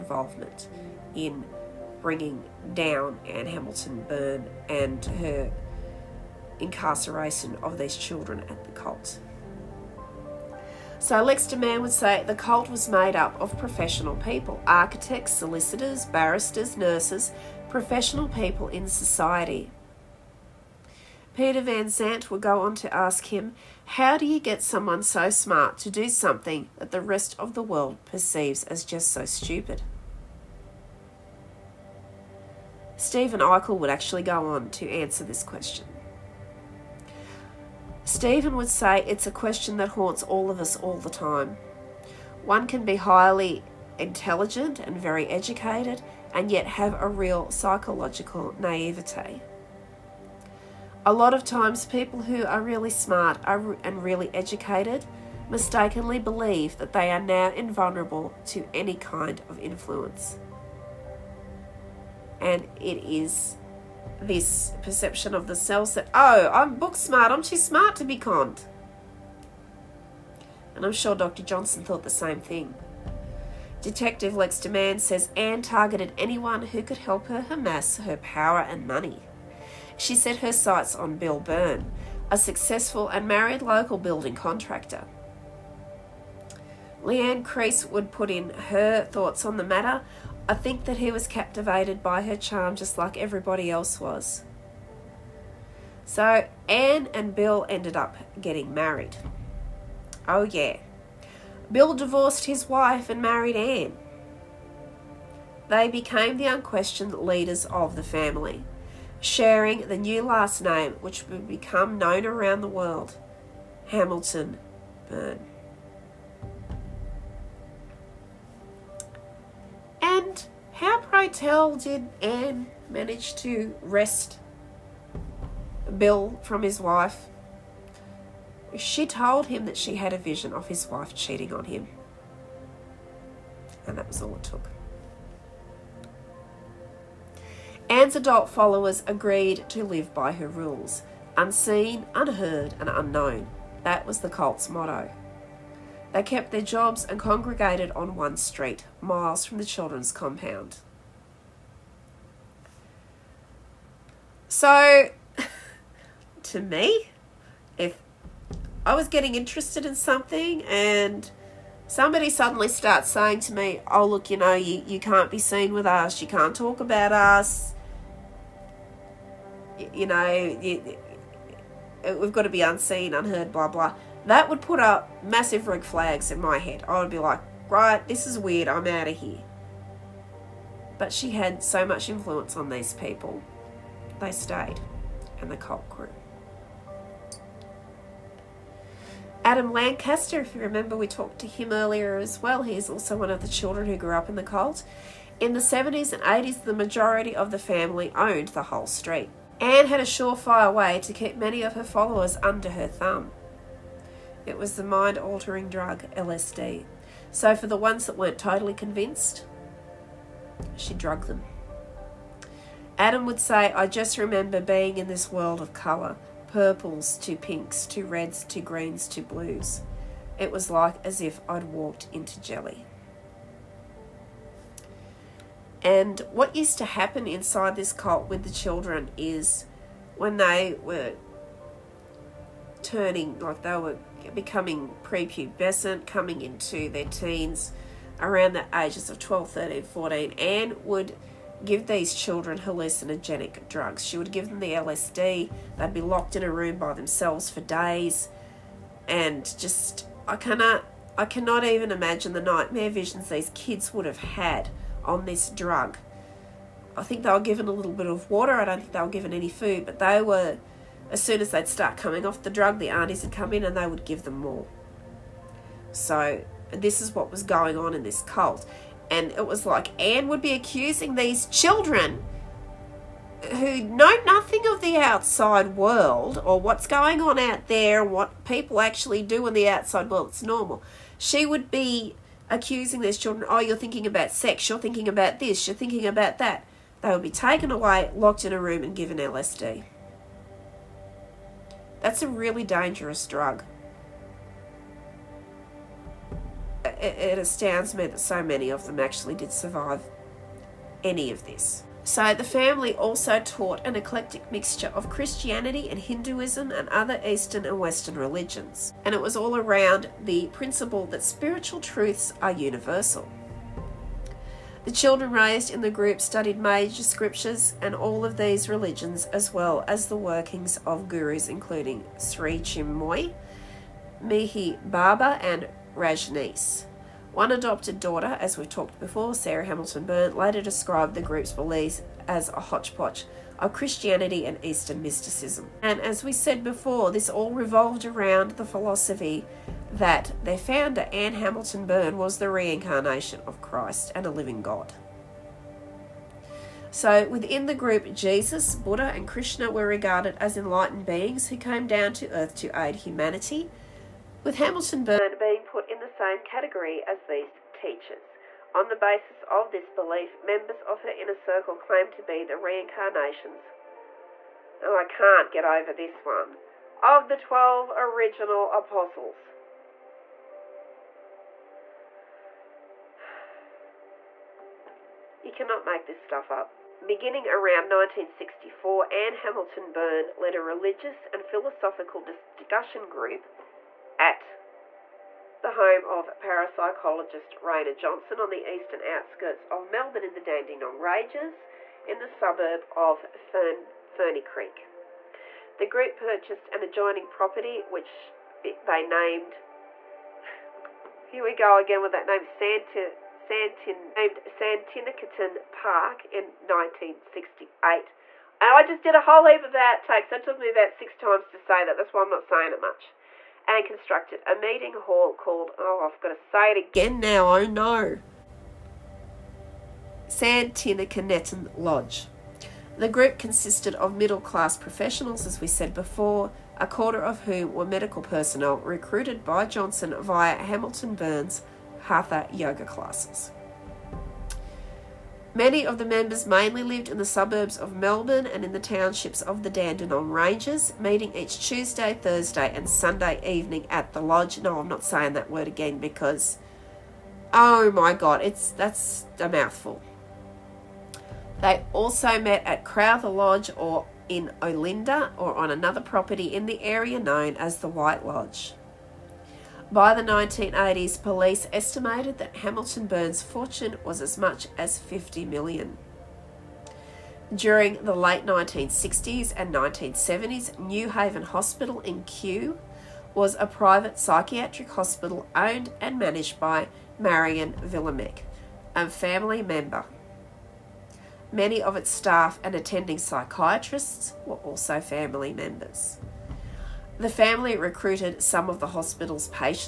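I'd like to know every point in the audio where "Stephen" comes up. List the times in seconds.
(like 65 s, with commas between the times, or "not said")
32 s, 38 s.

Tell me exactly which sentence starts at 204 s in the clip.
It was the mind altering drug, LSD.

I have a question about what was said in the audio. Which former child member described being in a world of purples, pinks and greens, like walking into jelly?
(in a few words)
Adam Lancaster.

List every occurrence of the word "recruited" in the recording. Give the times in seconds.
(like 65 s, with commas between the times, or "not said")
428 s, 487 s.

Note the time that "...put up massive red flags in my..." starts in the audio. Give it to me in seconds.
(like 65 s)
174 s.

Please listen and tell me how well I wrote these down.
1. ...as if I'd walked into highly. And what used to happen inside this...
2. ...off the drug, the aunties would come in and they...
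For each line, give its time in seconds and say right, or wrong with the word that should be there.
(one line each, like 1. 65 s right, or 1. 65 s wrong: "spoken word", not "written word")
1. 221 s wrong: "jelly", not "highly"
2. 262 s right.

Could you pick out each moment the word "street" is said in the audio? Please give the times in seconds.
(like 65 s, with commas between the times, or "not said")
148 s, 198 s.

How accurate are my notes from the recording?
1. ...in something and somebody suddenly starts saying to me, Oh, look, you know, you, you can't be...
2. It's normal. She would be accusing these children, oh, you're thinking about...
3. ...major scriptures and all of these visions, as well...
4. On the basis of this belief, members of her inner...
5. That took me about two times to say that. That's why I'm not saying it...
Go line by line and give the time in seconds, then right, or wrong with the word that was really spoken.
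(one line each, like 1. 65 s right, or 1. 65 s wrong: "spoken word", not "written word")
1. 159 s right
2. 280 s right
3. 316 s wrong: "religions", not "visions"
4. 358 s right
5. 410 s wrong: "six", not "two".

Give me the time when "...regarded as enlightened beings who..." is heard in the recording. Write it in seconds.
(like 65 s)
349 s.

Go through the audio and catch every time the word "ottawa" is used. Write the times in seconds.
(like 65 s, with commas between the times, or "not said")
not said.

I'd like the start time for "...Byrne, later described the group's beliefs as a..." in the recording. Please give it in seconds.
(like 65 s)
330 s.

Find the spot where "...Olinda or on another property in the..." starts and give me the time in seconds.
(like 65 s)
454 s.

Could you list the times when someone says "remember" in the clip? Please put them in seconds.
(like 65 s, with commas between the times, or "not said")
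190 s, 214 s.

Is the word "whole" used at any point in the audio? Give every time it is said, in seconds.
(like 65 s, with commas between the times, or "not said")
198 s, 409 s.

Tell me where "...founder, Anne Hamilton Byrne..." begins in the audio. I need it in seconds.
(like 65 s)
340 s.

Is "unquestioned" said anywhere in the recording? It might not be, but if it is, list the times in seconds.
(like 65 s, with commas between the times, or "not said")
106 s.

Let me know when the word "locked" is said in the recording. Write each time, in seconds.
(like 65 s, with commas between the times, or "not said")
246 s, 288 s.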